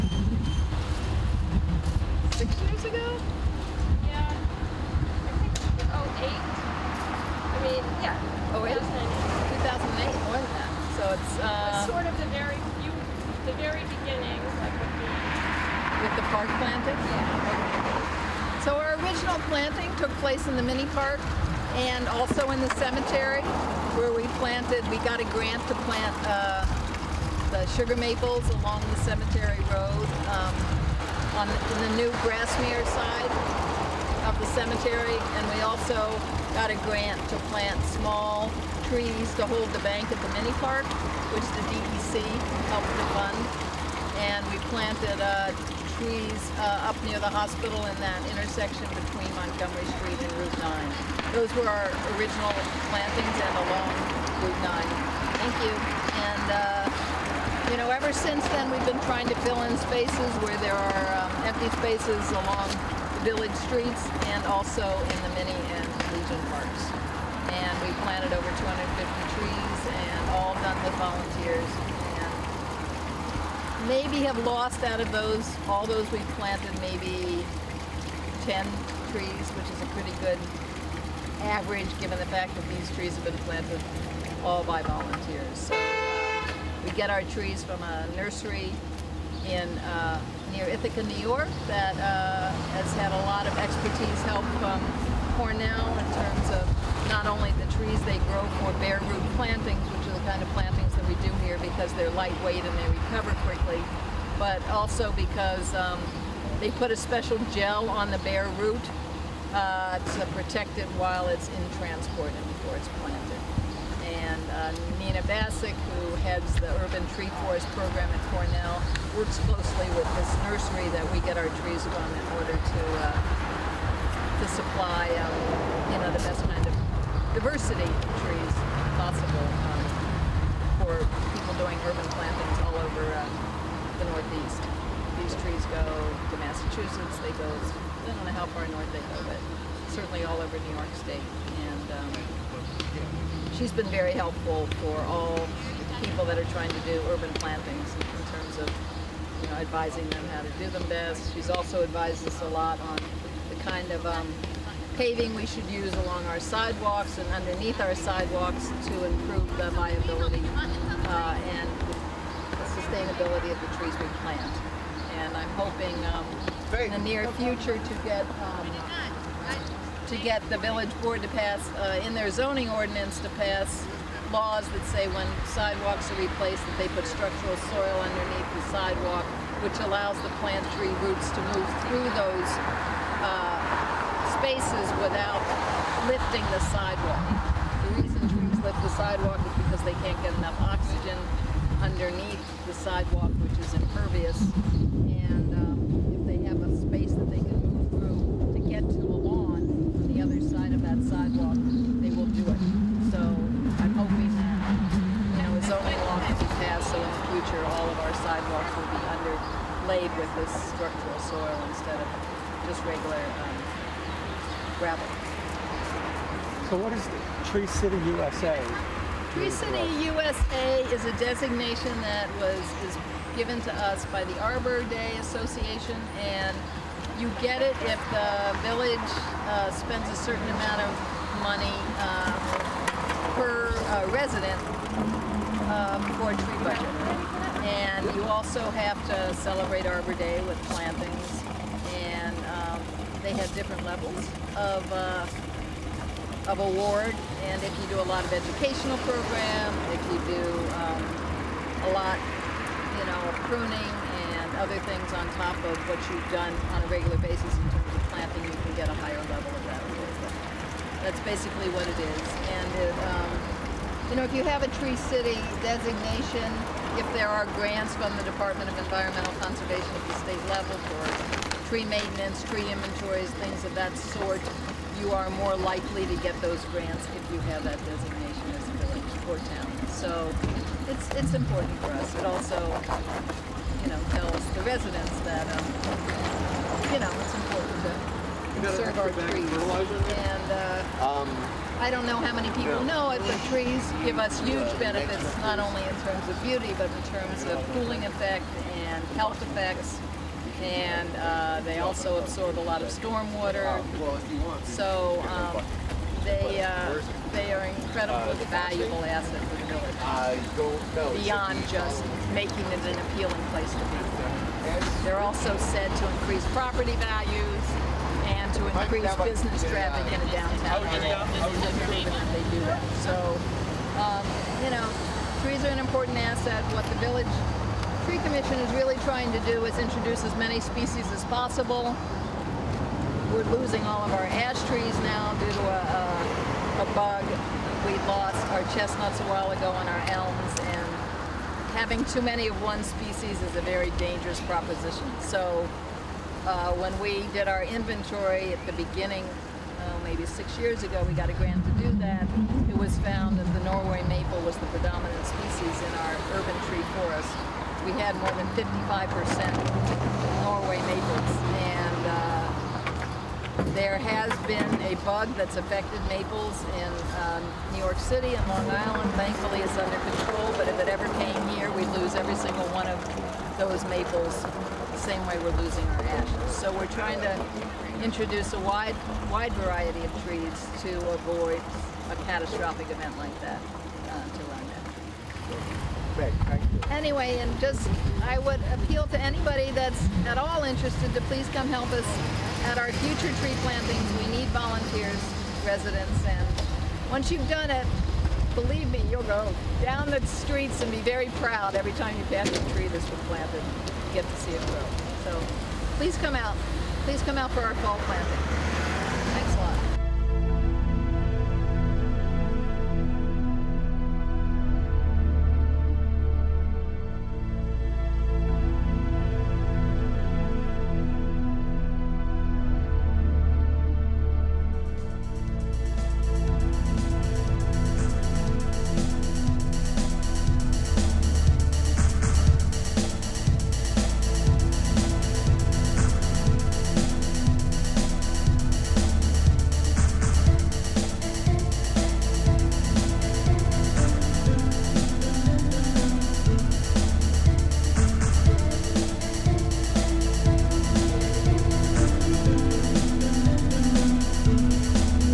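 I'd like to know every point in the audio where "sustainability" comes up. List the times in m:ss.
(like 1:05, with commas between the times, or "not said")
2:42.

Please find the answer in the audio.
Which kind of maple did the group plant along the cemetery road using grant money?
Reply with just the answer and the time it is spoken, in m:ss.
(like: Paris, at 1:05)
Sugar maples, at 0:27.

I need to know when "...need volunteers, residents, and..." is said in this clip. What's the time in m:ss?
6:34.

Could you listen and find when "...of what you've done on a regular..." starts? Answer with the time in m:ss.
4:15.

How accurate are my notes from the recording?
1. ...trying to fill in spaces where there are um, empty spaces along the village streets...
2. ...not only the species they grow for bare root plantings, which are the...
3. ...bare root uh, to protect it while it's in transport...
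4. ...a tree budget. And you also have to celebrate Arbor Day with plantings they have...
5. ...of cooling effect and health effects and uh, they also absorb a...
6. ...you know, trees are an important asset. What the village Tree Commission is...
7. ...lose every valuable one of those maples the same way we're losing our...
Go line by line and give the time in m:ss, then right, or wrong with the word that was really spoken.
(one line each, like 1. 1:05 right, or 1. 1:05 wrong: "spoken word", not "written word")
1. 0:59 right
2. 1:37 wrong: "trees", not "species"
3. 1:48 right
4. 3:56 right
5. 4:57 right
6. 5:24 right
7. 6:11 wrong: "single", not "valuable".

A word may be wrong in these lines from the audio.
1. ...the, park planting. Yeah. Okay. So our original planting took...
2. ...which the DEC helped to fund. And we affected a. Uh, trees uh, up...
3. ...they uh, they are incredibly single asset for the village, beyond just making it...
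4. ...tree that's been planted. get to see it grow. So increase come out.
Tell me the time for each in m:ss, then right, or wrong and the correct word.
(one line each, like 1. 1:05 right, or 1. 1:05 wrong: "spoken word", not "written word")
1. 0:16 right
2. 0:41 wrong: "planted", not "affected"
3. 5:06 wrong: "valuable", not "single"
4. 6:42 wrong: "please", not "increase".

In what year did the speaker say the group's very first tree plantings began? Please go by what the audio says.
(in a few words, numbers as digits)
2008.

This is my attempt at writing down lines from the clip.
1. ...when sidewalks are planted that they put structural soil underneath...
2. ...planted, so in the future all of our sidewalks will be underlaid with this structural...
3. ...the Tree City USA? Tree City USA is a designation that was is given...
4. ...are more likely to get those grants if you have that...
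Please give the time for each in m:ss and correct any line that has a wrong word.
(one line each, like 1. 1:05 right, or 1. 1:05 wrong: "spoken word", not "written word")
1. 2:55 wrong: "replaced", not "planted"
2. 3:26 wrong: "passed", not "planted"
3. 3:37 right
4. 4:35 right.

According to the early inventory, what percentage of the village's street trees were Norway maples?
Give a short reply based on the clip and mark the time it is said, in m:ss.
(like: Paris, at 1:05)
More than 55%, at 5:58.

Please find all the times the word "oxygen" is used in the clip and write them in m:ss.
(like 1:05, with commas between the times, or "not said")
3:10.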